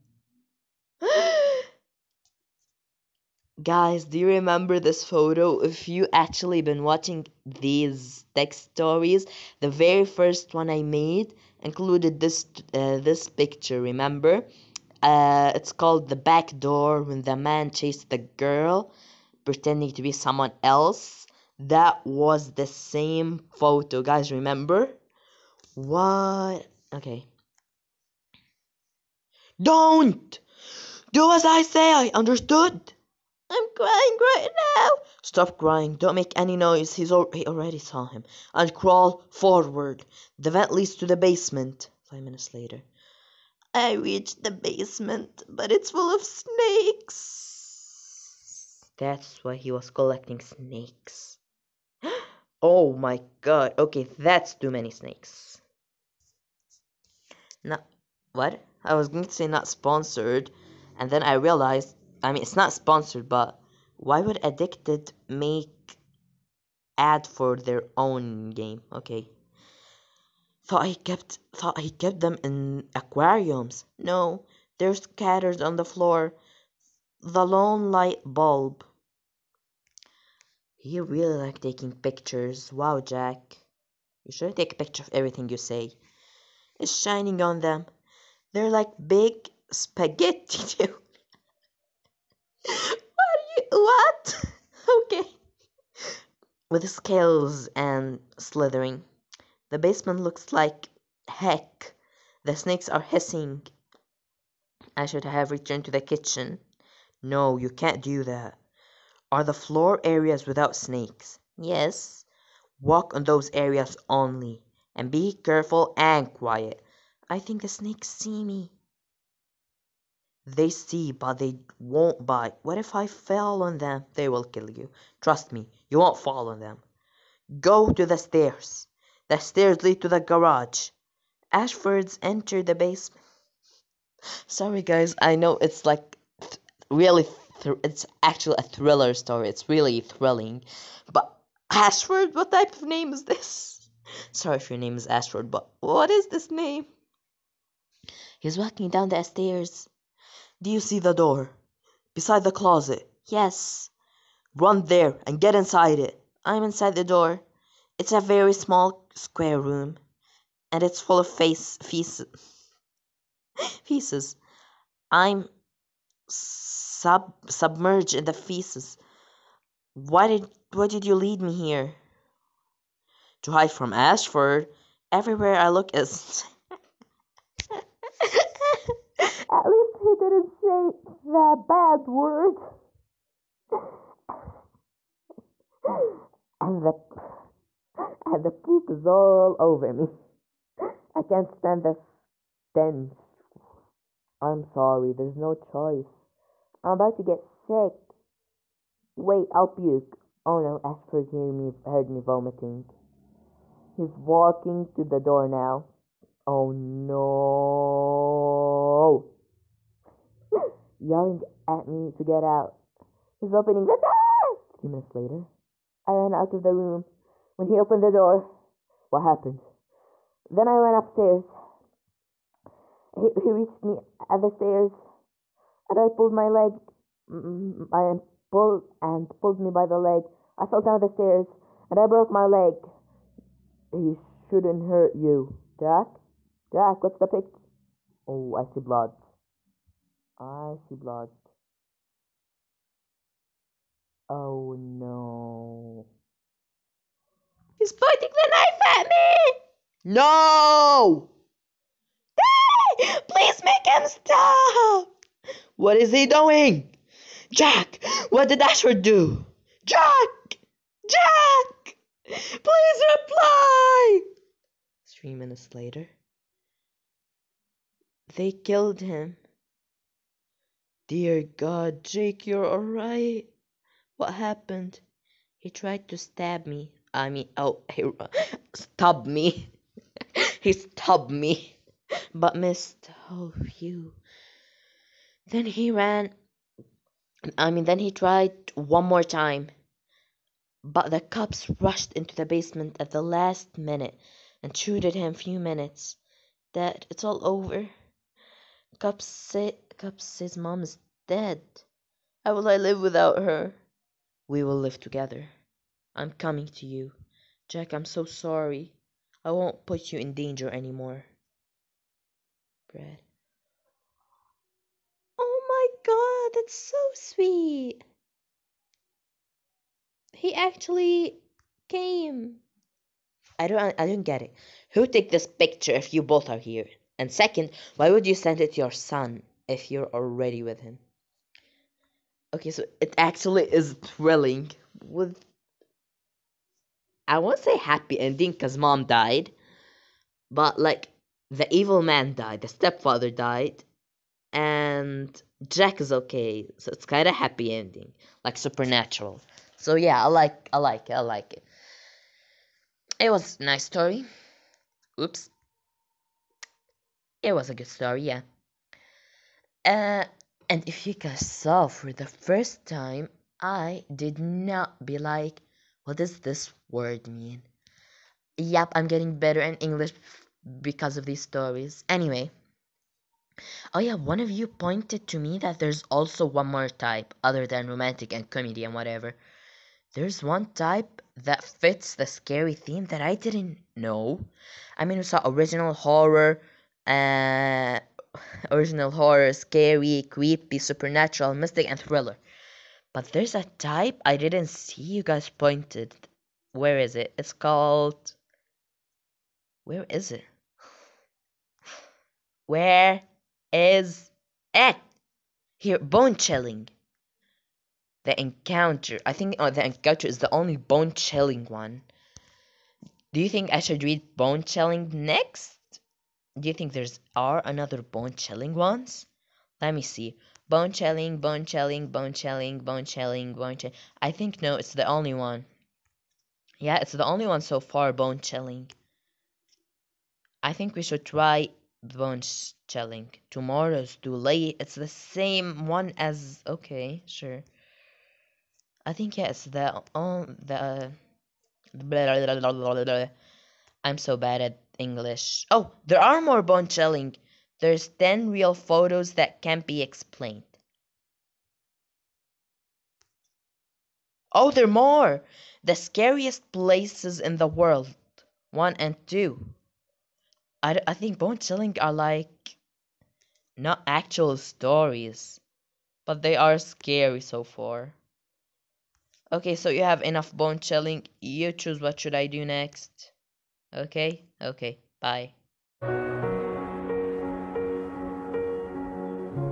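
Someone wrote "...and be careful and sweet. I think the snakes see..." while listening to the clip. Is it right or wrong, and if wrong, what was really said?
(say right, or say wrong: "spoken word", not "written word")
wrong: "quiet", not "sweet".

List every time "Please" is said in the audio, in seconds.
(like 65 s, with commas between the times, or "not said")
253 s, 262 s.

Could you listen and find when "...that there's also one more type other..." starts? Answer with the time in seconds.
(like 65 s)
375 s.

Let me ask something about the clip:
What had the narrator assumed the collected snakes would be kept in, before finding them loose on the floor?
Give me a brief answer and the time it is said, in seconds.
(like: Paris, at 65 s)
Aquariums, at 72 s.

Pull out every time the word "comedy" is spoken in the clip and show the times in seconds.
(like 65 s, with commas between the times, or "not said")
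378 s.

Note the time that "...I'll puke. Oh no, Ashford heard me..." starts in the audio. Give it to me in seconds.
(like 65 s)
199 s.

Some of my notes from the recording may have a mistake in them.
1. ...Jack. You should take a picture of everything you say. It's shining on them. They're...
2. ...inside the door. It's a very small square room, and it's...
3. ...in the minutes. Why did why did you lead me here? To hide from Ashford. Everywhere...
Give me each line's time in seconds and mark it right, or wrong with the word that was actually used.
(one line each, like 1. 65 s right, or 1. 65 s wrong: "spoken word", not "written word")
1. 83 s right
2. 156 s right
3. 168 s wrong: "feces", not "minutes".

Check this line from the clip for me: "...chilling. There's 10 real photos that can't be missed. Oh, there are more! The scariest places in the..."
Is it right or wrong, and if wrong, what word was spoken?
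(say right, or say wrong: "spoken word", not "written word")
wrong: "explained", not "missed".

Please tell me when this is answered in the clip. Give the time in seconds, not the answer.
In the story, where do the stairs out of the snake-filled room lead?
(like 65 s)
129 s.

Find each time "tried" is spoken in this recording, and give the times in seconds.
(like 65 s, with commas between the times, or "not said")
275 s, 288 s.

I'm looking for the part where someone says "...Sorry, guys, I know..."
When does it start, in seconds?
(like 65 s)
134 s.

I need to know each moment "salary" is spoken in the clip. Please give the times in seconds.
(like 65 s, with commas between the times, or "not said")
not said.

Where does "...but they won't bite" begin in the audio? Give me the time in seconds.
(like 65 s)
121 s.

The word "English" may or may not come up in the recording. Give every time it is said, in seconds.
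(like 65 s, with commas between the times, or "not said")
369 s, 444 s.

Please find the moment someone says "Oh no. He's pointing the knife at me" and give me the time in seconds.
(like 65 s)
244 s.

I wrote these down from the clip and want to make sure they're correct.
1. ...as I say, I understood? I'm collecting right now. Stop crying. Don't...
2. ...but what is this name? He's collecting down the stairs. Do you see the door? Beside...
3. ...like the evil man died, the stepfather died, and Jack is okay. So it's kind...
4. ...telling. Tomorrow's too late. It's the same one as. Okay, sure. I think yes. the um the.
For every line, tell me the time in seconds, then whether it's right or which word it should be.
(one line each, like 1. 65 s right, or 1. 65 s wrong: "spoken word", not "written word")
1. 31 s wrong: "crying", not "collecting"
2. 145 s wrong: "walking", not "collecting"
3. 340 s right
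4. 432 s right.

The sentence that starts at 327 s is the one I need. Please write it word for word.
And second, why would you send it to your son if you're already with him?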